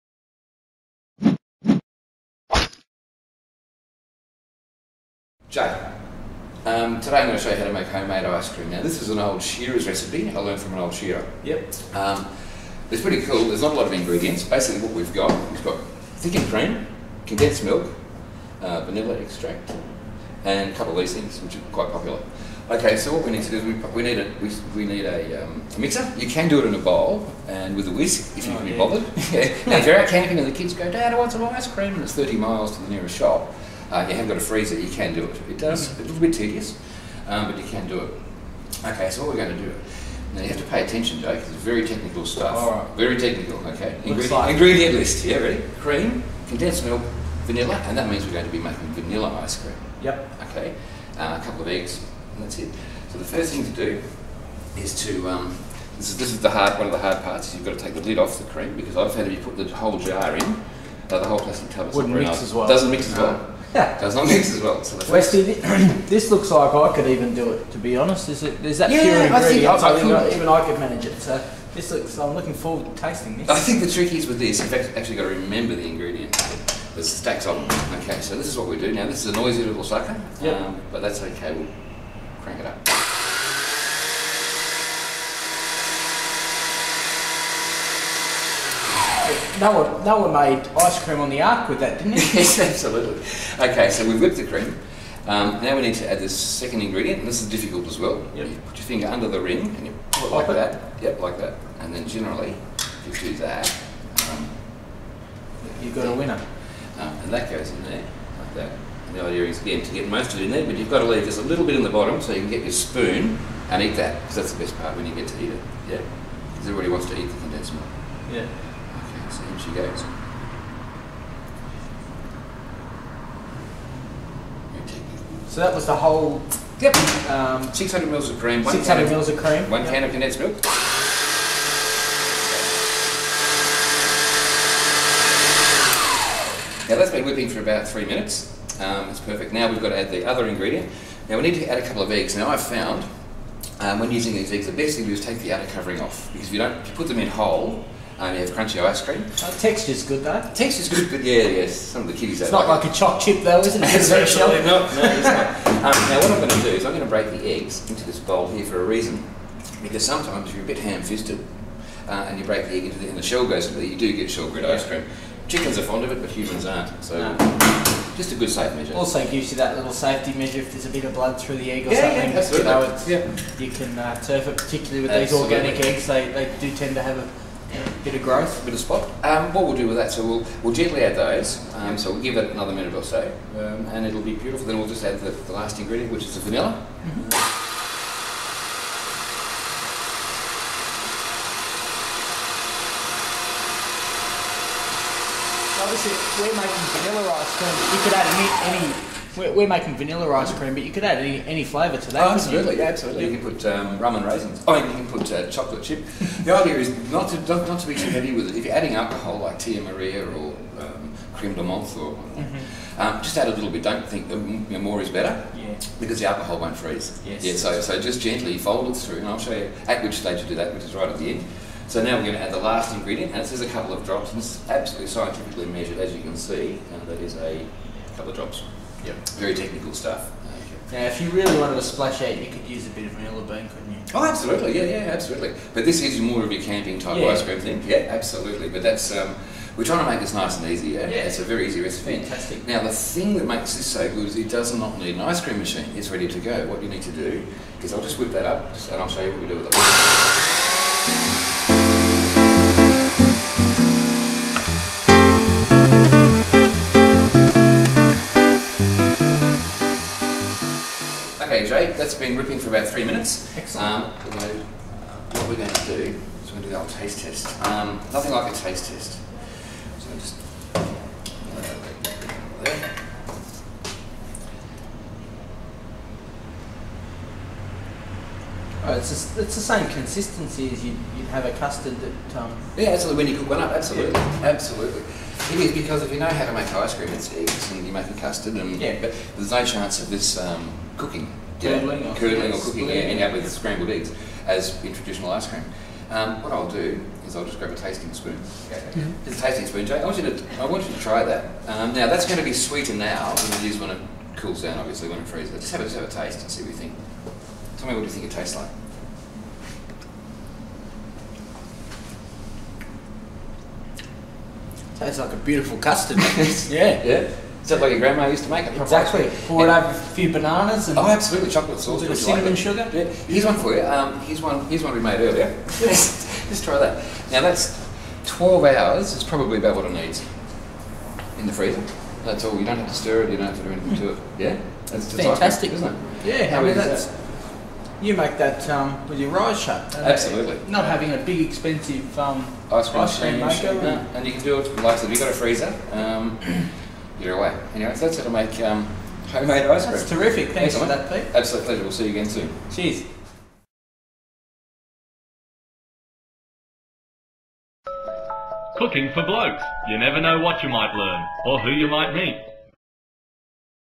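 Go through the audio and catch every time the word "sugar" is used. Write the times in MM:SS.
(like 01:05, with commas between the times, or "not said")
05:22.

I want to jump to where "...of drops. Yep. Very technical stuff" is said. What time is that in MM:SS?
03:48.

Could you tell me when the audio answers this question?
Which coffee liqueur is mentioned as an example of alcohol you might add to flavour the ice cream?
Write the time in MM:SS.
03:29.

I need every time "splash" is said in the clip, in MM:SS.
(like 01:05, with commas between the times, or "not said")
03:51.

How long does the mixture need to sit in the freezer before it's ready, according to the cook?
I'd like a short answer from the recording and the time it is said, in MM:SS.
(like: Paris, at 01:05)
12 hours, at 05:28.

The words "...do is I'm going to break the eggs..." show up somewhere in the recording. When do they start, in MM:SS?
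02:36.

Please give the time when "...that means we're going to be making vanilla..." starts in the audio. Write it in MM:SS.
00:47.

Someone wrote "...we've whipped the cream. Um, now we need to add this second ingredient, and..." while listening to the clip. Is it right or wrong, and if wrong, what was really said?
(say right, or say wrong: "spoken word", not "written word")
right.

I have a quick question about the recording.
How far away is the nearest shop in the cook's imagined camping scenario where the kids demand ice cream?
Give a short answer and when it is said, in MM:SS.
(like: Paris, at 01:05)
30 miles, at 00:32.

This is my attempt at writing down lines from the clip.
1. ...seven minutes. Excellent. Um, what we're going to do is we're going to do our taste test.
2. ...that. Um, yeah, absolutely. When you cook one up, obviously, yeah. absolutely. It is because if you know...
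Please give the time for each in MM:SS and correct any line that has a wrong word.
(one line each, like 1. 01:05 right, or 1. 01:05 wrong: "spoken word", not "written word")
1. 04:22 wrong: "three", not "seven"
2. 04:41 wrong: "absolutely", not "obviously".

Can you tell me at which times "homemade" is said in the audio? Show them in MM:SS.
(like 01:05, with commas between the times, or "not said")
00:07, 05:49.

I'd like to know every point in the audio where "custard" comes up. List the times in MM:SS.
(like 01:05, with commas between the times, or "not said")
04:41, 04:48, 05:15.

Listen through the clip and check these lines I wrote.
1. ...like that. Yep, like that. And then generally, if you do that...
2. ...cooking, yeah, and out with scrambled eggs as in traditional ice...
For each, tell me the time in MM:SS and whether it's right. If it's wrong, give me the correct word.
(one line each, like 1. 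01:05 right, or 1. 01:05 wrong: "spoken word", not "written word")
1. 01:40 right
2. 04:52 right.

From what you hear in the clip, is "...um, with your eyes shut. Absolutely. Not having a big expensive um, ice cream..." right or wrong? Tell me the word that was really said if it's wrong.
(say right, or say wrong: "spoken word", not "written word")
right.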